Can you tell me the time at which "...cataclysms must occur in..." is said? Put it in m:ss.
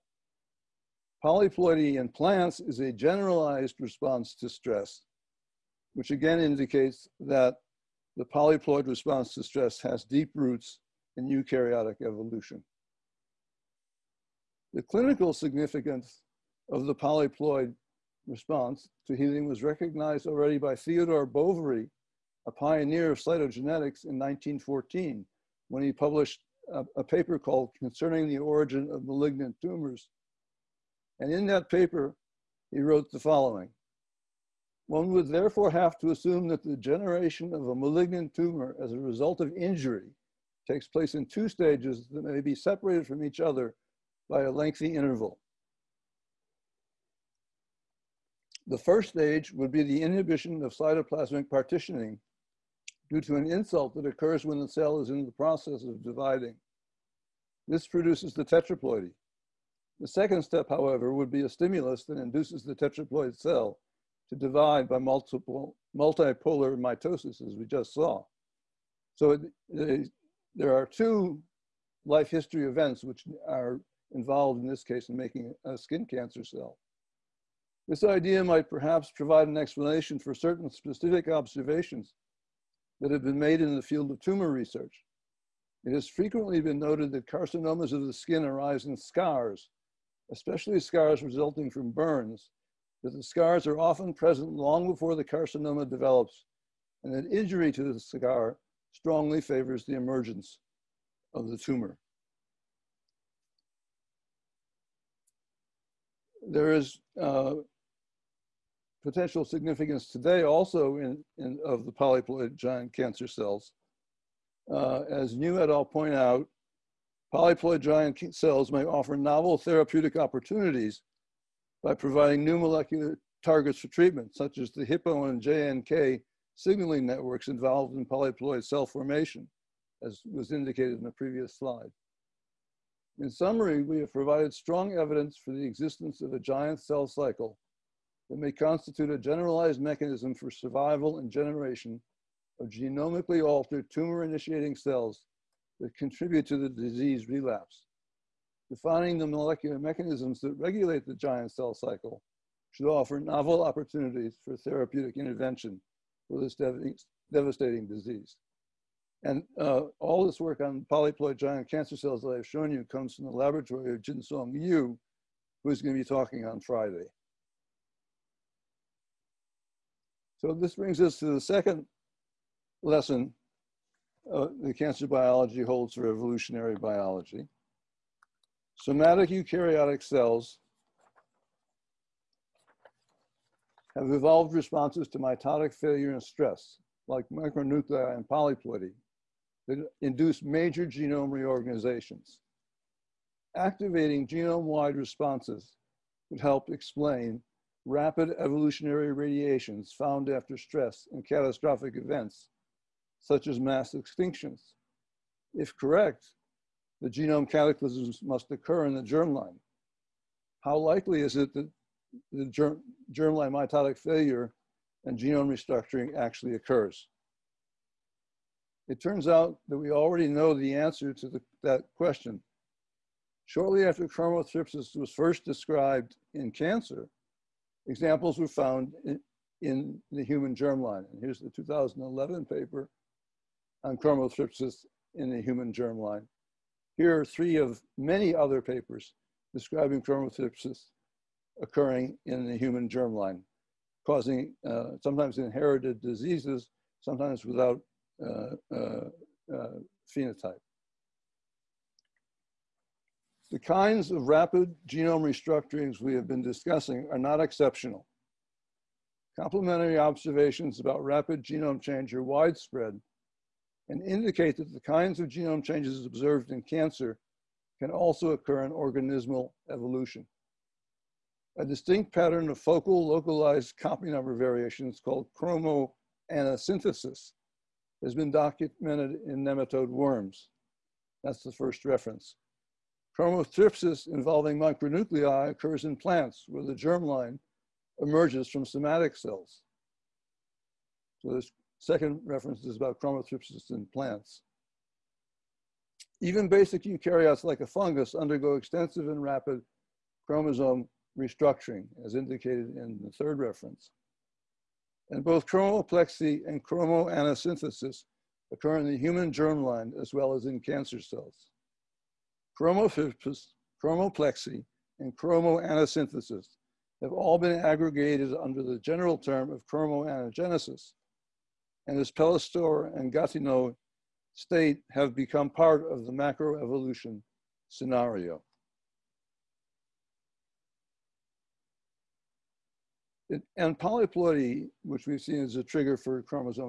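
3:27.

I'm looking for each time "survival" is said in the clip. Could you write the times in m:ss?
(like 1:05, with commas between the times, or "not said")
2:20.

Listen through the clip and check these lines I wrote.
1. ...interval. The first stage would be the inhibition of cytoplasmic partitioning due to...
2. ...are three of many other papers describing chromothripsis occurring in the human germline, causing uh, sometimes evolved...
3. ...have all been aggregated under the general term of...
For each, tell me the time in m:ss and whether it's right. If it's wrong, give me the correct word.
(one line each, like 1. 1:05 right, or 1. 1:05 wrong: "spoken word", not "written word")
1. 0:44 right
2. 3:57 wrong: "inherited", not "evolved"
3. 5:17 right.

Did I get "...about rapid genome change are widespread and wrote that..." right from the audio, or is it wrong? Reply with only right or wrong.
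wrong.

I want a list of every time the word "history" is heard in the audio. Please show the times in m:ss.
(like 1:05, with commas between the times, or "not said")
1:12.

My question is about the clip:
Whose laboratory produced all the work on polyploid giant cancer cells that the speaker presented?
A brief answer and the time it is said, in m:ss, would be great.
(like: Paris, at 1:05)
Jin Song Liu, at 2:44.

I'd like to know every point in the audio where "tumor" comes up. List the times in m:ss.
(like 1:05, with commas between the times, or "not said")
0:29, 0:38, 1:24, 1:41, 2:23.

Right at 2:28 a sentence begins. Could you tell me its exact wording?
Defining the molecular mechanisms that regulate the giant cell cycle should offer novel opportunities for therapeutic intervention for this devastating disease.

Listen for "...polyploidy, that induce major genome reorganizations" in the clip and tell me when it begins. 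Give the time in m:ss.
3:08.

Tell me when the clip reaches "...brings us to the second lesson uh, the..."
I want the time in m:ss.
2:50.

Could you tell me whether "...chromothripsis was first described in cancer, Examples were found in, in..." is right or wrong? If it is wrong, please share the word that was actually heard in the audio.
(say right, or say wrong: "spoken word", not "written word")
right.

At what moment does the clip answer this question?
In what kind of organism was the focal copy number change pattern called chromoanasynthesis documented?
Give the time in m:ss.
4:39.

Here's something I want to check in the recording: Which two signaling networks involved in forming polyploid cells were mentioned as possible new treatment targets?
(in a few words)
Hippo and JNK.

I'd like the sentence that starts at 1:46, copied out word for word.
There is uh, potential significance today also in, in of the polyploid giant cancer cells.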